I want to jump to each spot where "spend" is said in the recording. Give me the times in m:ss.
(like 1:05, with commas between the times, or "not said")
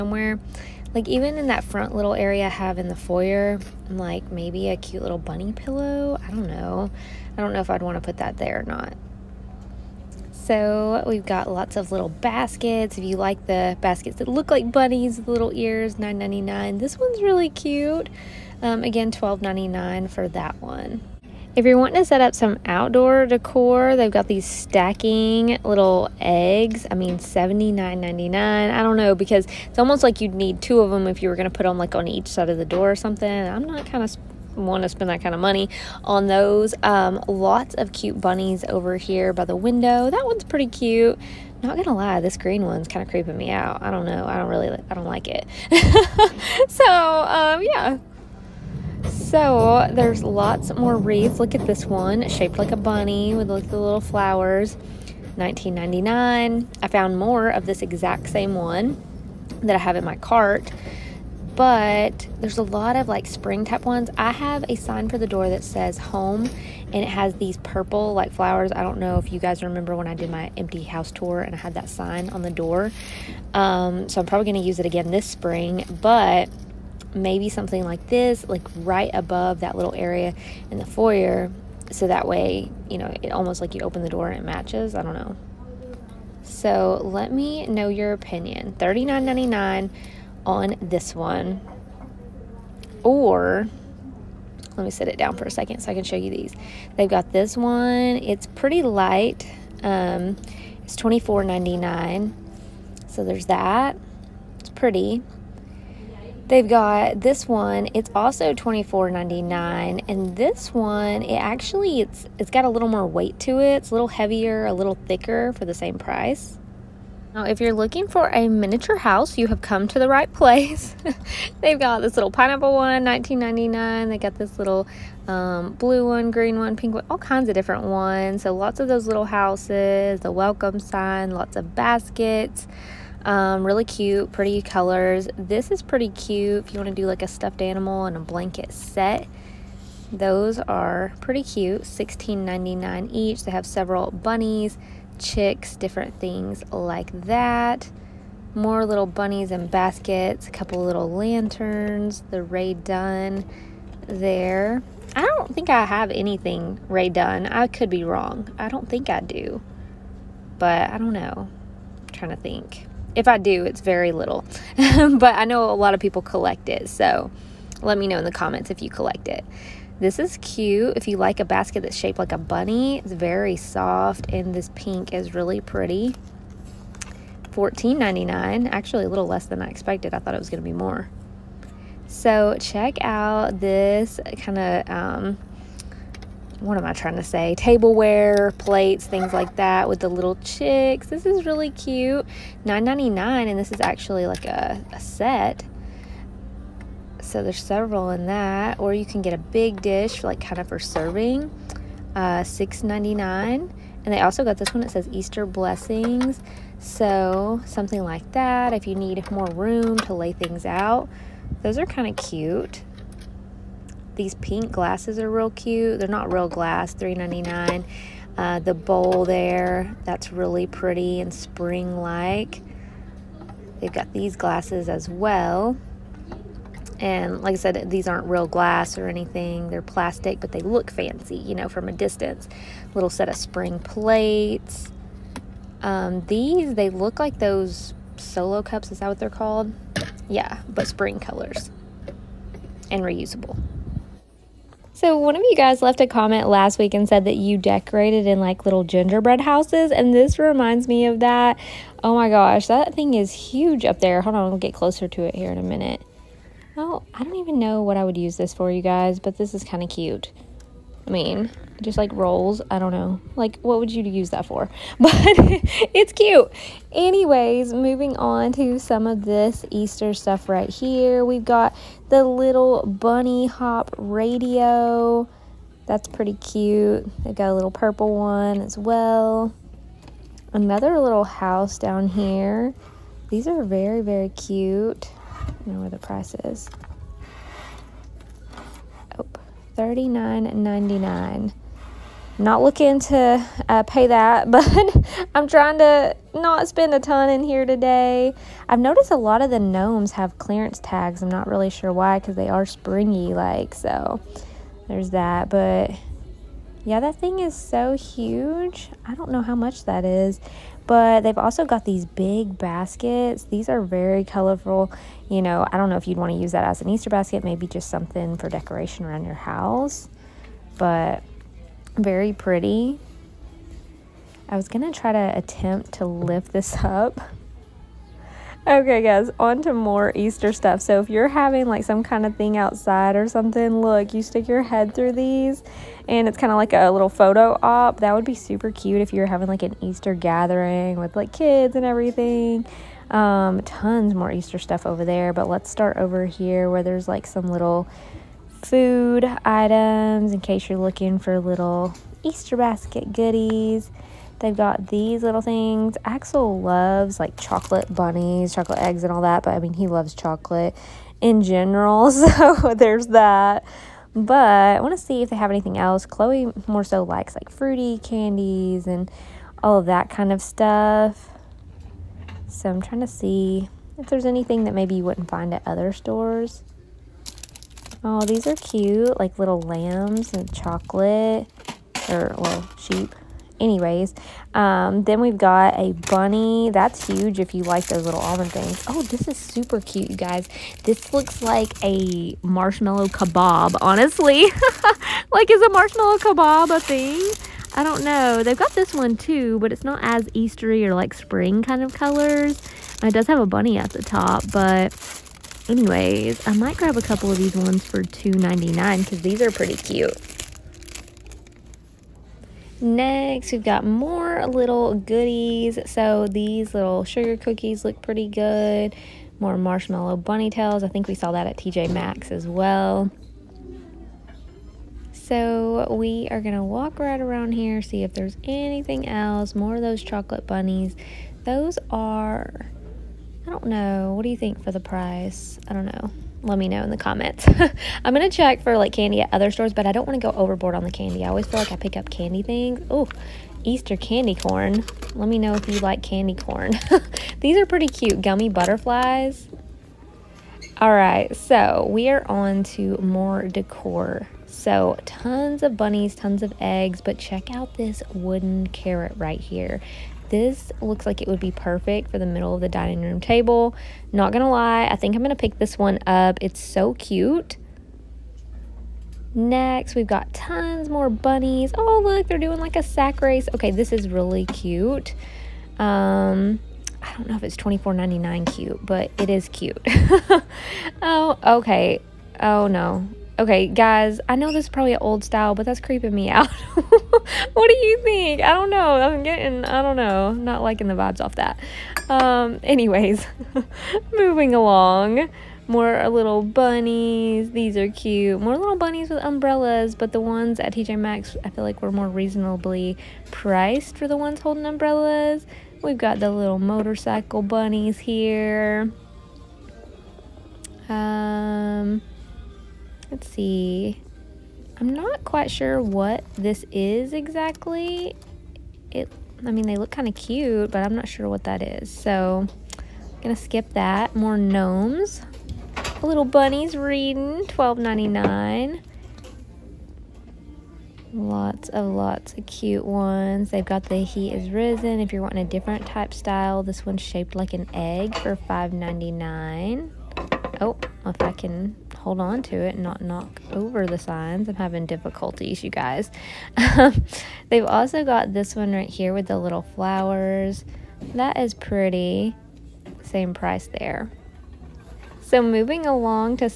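0:34, 4:56.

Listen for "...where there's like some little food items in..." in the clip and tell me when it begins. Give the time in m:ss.
5:46.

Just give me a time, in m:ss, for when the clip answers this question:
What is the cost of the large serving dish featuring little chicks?
3:22.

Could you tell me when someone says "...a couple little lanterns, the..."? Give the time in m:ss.
2:30.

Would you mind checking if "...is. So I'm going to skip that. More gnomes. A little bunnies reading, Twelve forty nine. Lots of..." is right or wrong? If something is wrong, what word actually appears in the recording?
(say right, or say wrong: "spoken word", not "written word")
wrong: "ninety", not "forty".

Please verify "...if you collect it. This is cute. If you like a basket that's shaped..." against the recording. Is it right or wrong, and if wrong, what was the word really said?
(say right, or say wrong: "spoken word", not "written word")
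right.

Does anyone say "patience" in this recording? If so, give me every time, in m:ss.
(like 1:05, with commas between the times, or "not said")
not said.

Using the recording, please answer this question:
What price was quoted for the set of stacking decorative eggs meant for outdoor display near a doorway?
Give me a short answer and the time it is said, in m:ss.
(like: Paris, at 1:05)
$79.99, at 0:27.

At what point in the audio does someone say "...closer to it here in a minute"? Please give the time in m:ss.
4:14.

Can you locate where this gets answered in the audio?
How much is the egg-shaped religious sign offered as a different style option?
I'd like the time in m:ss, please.
8:58.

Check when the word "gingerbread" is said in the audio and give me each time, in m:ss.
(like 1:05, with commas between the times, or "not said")
4:08.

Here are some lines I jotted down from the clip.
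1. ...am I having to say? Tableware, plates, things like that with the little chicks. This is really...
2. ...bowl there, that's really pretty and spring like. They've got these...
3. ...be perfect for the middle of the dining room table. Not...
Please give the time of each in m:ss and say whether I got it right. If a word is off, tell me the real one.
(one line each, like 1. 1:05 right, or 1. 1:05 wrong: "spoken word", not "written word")
1. 3:06 wrong: "trying", not "having"
2. 3:38 right
3. 7:41 right.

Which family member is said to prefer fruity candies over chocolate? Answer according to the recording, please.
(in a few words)
Chloe.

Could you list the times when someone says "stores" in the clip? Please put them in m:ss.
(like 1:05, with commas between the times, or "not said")
6:15, 7:19.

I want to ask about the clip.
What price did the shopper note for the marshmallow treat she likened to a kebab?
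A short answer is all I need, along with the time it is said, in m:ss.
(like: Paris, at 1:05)
$2.99, at 6:48.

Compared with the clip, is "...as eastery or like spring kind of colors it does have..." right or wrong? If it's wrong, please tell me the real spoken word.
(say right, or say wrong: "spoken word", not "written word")
right.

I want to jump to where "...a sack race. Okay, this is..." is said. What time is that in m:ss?
7:52.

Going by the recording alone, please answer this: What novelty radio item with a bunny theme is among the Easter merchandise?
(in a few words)
bunny hop radio.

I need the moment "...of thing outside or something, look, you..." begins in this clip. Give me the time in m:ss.
5:32.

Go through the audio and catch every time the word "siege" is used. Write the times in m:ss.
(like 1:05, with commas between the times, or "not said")
not said.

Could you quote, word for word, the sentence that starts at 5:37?
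That would be super cute if you're having like an Easter gathering with like kids and everything.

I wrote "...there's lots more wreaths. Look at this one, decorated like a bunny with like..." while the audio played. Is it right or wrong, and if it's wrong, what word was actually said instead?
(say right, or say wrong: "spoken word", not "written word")
wrong: "shaped", not "decorated".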